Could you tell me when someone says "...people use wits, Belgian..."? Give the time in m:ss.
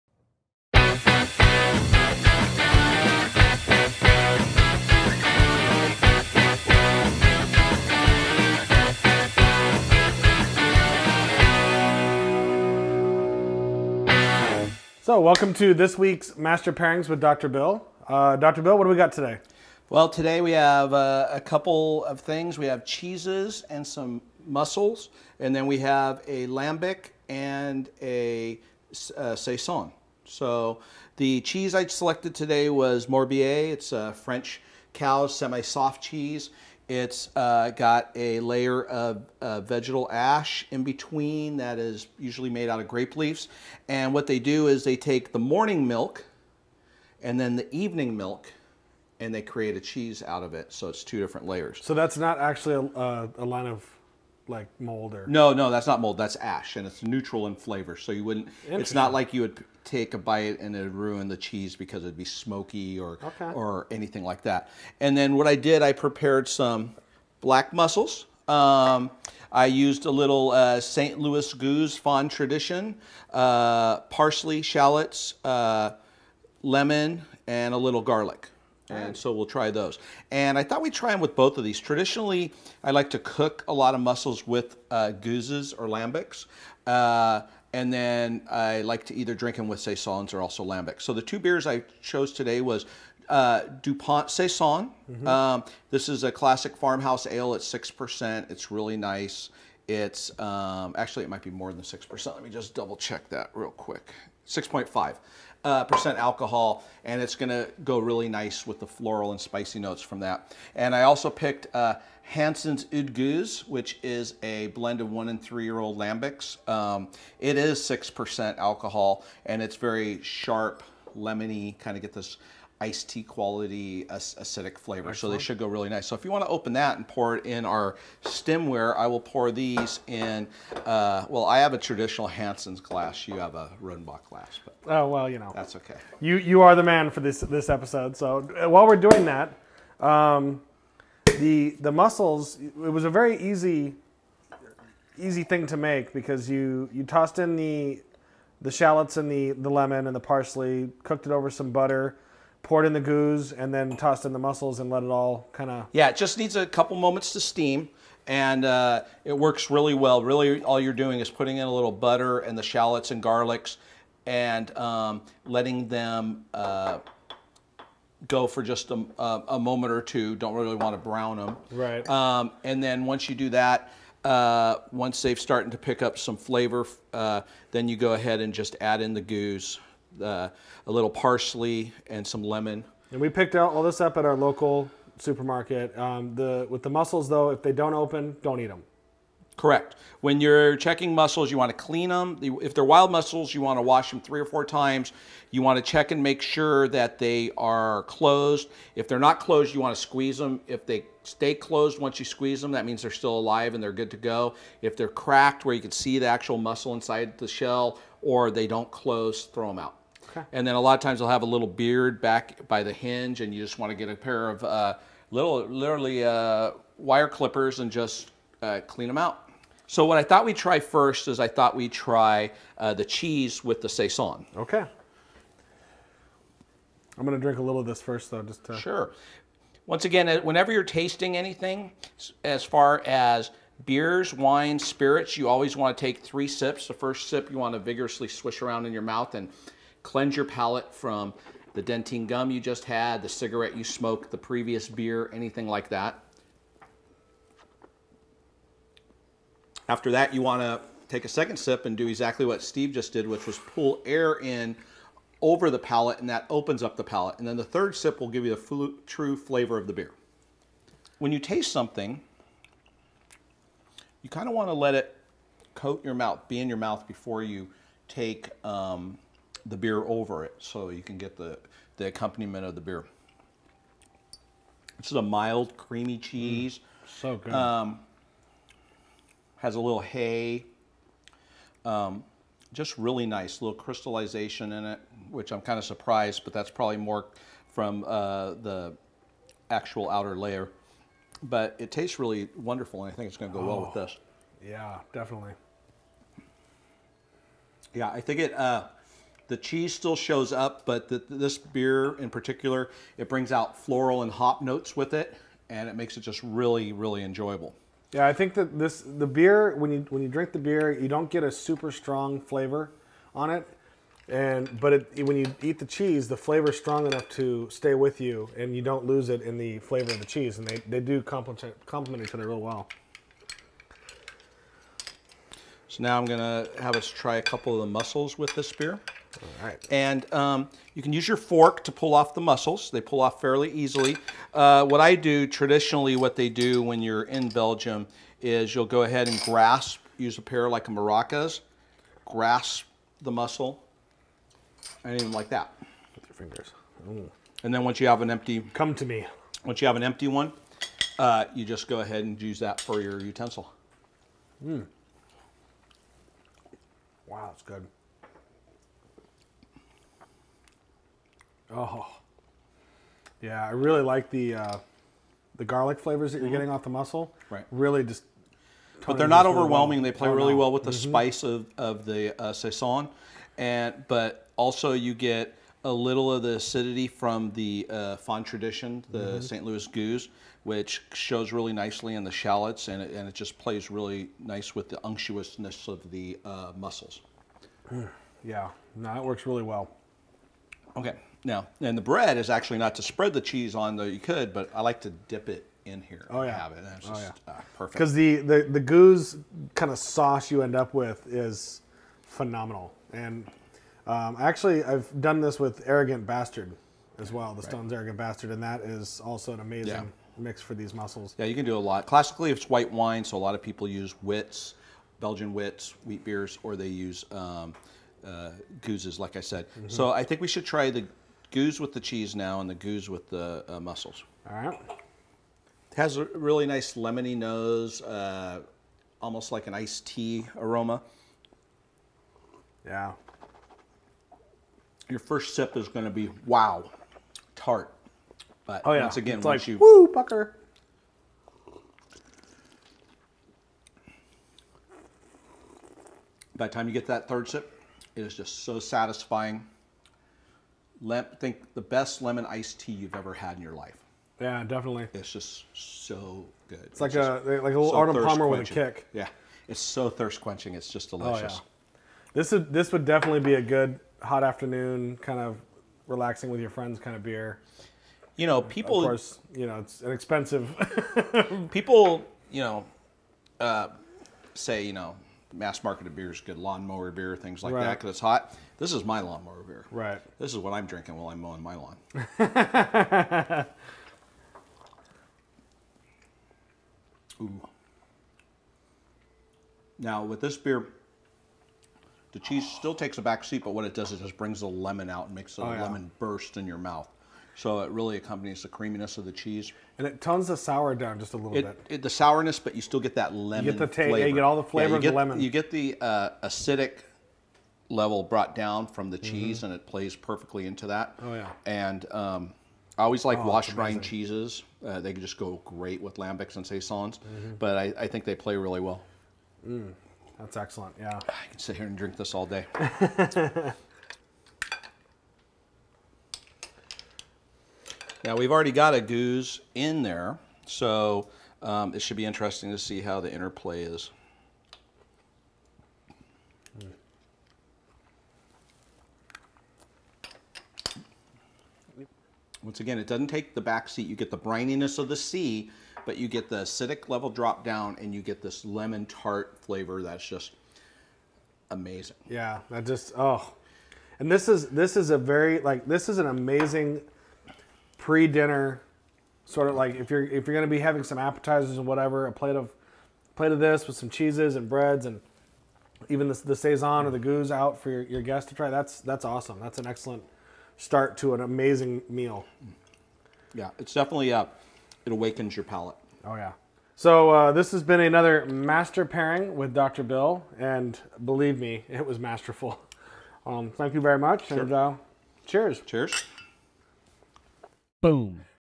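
6:53.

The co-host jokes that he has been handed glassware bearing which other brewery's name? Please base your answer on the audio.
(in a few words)
Rodenbach.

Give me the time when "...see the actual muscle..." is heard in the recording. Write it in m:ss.
3:25.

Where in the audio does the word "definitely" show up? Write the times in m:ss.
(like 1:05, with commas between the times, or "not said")
4:55, 7:34, 7:43, 9:33.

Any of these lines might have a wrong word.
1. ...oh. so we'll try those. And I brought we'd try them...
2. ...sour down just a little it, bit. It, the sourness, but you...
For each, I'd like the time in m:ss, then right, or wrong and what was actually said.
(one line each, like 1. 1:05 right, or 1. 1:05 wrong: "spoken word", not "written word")
1. 1:19 wrong: "thought", not "brought"
2. 8:20 right.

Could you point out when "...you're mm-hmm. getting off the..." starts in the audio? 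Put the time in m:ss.
6:06.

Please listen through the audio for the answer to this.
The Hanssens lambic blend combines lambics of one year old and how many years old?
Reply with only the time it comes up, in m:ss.
1:55.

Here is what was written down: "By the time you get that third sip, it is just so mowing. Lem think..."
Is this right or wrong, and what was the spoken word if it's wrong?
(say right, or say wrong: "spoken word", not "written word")
wrong: "satisfying", not "mowing".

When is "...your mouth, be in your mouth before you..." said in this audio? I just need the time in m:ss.
4:26.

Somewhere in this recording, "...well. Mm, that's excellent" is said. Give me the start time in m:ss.
8:38.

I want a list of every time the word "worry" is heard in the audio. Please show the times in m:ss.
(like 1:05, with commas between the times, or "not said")
not said.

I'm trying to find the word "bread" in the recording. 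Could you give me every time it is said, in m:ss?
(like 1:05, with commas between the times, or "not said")
6:32, 9:24.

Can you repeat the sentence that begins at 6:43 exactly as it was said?
And um, actually, I've done this with Arrogant Bastard as well, the right.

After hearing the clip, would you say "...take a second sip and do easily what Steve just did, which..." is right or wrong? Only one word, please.
wrong.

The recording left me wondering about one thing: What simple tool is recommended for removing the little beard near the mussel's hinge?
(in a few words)
Wire clippers.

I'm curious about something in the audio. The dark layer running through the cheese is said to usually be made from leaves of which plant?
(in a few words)
Grape leaves.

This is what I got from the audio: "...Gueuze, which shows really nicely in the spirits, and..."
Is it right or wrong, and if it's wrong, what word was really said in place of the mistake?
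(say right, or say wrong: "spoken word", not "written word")
wrong: "shallots", not "spirits".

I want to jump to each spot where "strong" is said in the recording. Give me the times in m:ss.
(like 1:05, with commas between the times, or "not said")
5:11, 5:16.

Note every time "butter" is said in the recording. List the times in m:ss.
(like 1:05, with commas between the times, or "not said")
2:31, 2:41.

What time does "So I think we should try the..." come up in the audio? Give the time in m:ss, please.
6:59.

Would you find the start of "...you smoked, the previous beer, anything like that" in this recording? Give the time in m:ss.
4:03.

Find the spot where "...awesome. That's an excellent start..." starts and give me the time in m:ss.
9:29.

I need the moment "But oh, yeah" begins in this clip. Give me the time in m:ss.
7:18.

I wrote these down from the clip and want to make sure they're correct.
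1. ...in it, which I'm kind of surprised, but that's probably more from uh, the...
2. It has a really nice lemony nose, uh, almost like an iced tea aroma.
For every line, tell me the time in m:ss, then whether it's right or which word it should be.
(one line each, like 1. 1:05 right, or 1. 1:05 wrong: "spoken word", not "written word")
1. 4:44 right
2. 7:05 right.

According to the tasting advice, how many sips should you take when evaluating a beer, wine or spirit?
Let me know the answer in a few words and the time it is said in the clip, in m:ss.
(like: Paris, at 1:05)
3, at 3:56.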